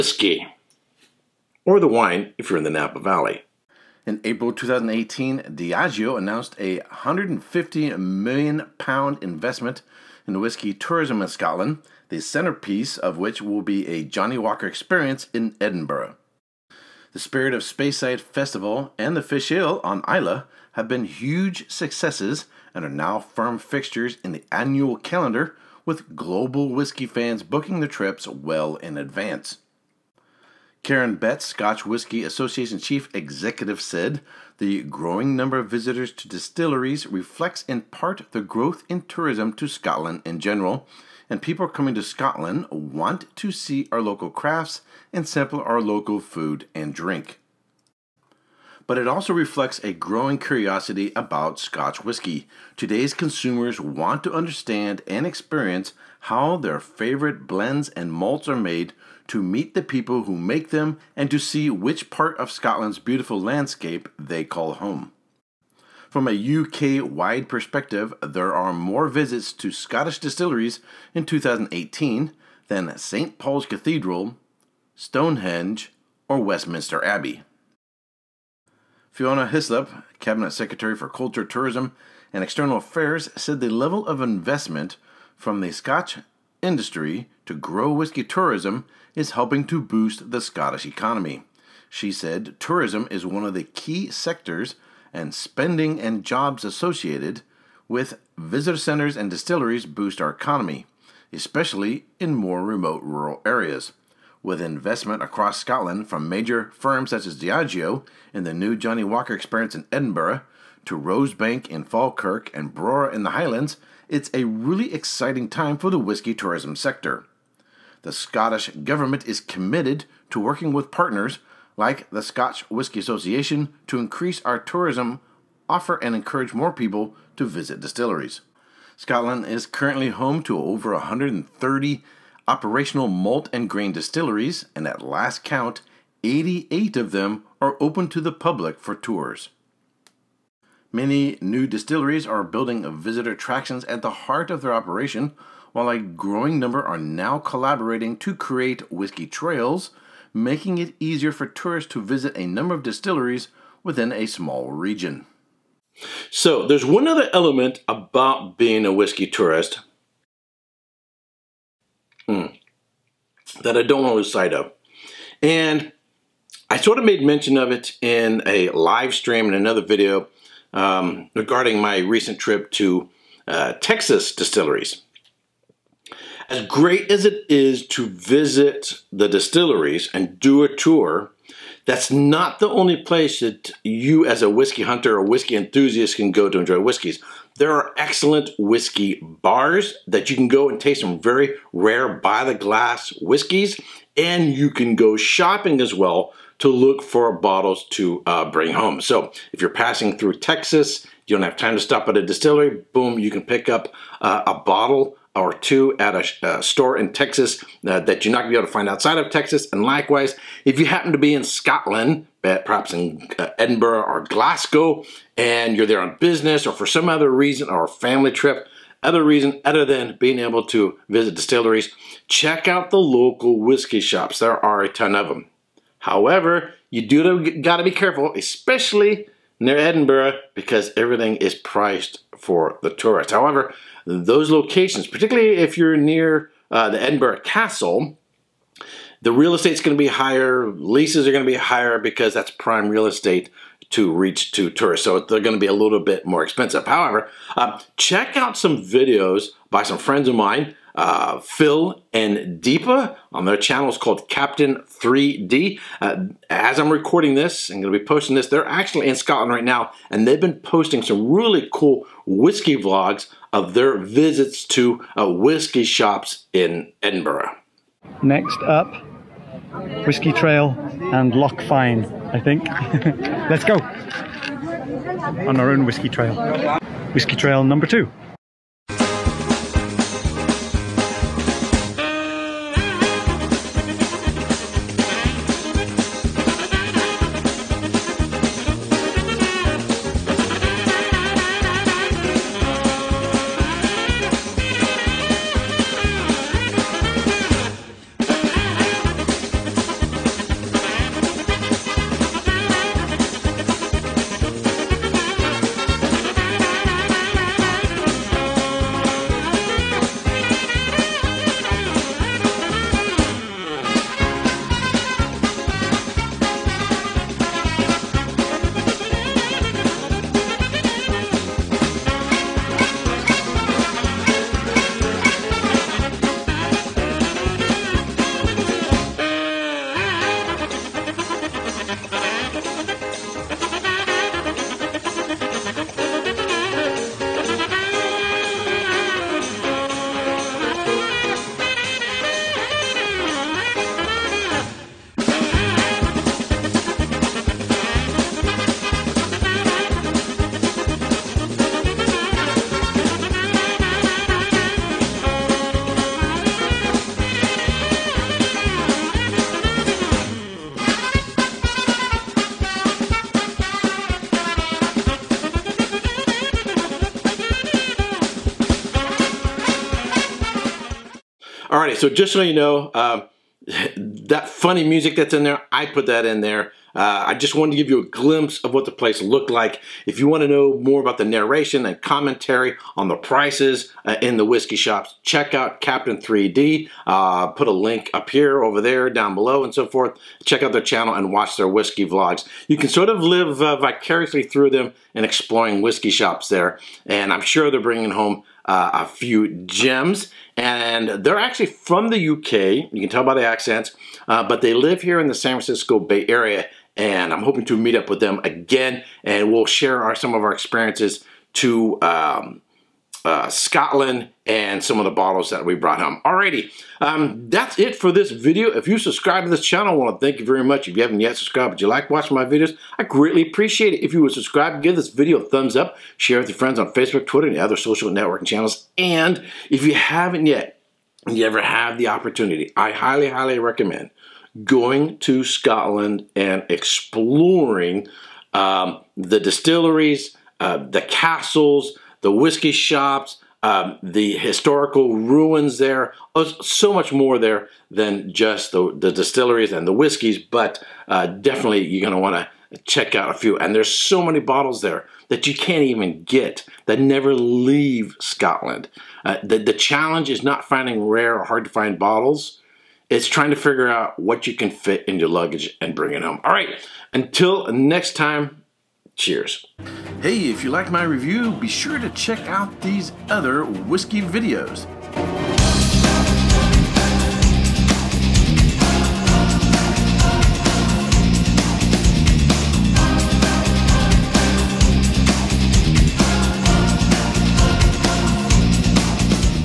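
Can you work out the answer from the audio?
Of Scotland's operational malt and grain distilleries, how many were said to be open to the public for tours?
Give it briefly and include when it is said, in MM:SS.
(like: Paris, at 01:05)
88, at 02:16.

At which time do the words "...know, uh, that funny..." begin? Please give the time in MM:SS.
06:12.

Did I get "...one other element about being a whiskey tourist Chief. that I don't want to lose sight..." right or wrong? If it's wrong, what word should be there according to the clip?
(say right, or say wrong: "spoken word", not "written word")
wrong: "Hmm", not "Chief".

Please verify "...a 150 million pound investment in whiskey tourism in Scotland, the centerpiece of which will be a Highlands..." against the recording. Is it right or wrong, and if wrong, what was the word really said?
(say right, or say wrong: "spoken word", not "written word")
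wrong: "Johnnie", not "Highlands".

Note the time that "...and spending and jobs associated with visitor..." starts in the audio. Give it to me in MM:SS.
01:35.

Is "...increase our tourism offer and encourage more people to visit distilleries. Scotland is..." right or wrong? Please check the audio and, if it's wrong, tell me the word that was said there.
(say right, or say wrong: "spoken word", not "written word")
right.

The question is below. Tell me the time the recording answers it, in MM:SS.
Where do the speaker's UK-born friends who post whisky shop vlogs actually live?
06:45.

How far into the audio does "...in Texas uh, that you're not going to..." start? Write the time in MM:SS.
03:26.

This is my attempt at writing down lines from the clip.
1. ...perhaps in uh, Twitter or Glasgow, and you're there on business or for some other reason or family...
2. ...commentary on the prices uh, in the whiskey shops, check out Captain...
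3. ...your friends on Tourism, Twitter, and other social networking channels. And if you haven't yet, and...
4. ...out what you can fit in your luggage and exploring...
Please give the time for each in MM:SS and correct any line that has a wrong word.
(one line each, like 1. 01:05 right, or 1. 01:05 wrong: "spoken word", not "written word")
1. 03:32 wrong: "Edinburgh", not "Twitter"
2. 06:22 right
3. 07:06 wrong: "Facebook", not "Tourism"
4. 07:43 wrong: "bring", not "exploring".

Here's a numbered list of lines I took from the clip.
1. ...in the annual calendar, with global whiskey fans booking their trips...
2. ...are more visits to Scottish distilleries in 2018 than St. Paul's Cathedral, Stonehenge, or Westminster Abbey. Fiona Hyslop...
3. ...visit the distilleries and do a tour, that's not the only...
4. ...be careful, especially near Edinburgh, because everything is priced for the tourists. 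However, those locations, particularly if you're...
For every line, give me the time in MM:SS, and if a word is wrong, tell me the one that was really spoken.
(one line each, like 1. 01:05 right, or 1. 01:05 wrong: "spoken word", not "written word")
1. 00:24 right
2. 01:08 right
3. 02:58 right
4. 03:47 right.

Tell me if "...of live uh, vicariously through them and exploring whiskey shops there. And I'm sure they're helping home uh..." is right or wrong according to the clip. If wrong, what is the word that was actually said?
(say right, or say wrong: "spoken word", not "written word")
wrong: "bringing", not "helping".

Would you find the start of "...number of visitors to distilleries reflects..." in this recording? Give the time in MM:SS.
00:35.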